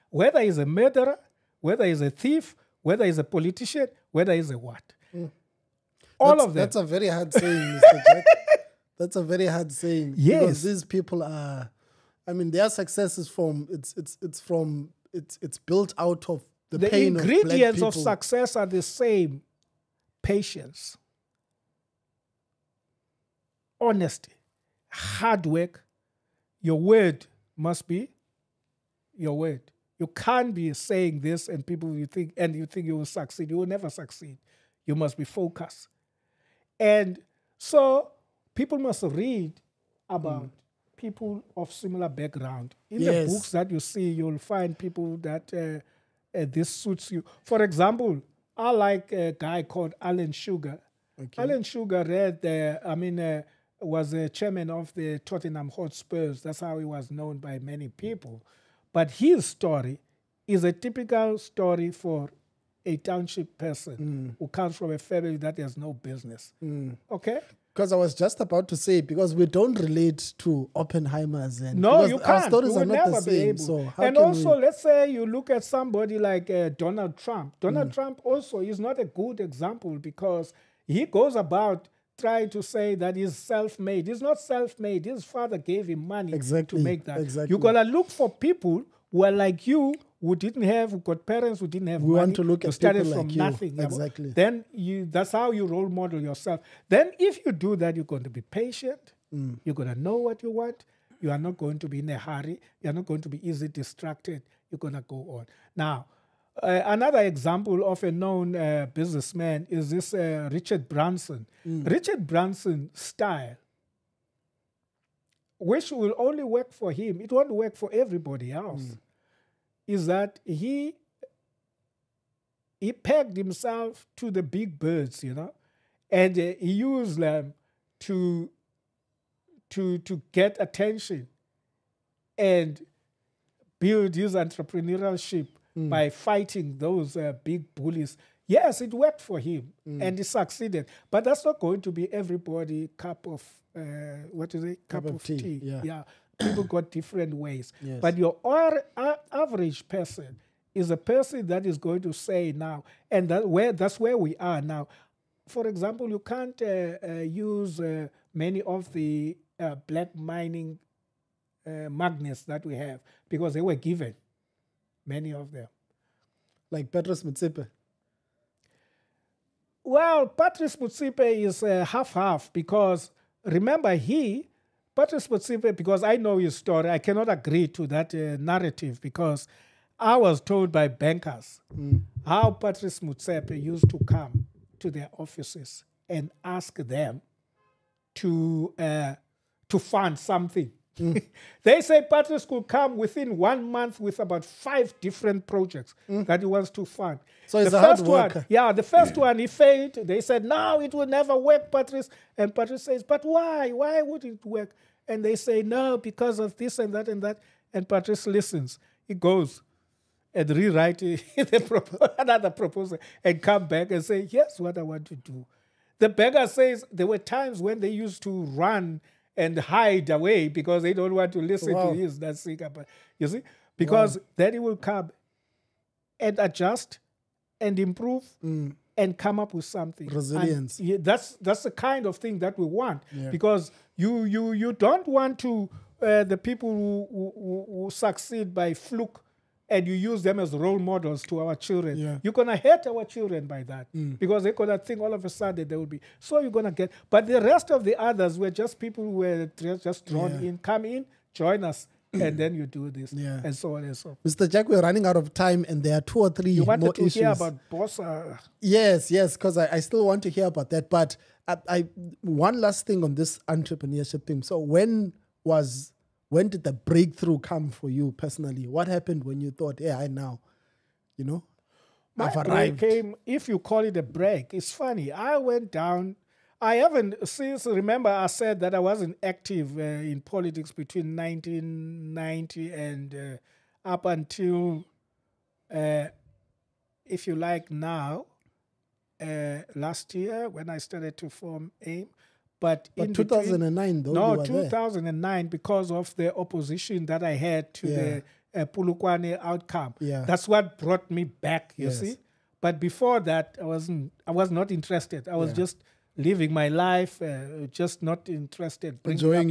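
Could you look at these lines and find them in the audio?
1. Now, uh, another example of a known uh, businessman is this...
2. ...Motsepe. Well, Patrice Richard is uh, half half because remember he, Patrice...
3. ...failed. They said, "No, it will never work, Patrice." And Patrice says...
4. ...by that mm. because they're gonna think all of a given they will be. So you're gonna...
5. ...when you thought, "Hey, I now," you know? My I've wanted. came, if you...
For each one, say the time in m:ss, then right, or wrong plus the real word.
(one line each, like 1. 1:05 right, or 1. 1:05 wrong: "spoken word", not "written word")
1. 1:45 right
2. 2:47 wrong: "Motsepe", not "Richard"
3. 3:19 right
4. 4:03 wrong: "sudden", not "given"
5. 4:29 wrong: "arrived", not "wanted".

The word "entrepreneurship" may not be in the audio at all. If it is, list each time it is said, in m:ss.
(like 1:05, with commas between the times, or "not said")
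2:14, 4:23.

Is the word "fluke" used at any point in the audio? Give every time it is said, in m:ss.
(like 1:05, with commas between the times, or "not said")
3:58.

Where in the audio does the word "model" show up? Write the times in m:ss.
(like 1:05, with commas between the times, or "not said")
1:35, 4:00.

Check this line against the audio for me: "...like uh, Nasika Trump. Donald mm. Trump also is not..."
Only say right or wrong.
wrong.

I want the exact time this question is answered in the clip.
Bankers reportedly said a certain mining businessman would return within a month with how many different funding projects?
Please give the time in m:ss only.
3:14.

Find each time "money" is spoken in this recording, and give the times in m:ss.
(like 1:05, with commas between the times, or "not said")
1:26, 1:32.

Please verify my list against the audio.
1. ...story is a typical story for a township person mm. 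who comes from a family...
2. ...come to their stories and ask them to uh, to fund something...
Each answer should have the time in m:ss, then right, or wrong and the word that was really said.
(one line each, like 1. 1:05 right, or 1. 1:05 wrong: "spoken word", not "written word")
1. 0:59 right
2. 3:04 wrong: "offices", not "stories".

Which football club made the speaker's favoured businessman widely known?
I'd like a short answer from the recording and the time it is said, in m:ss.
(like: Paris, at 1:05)
Tottenham Hotspurs, at 0:55.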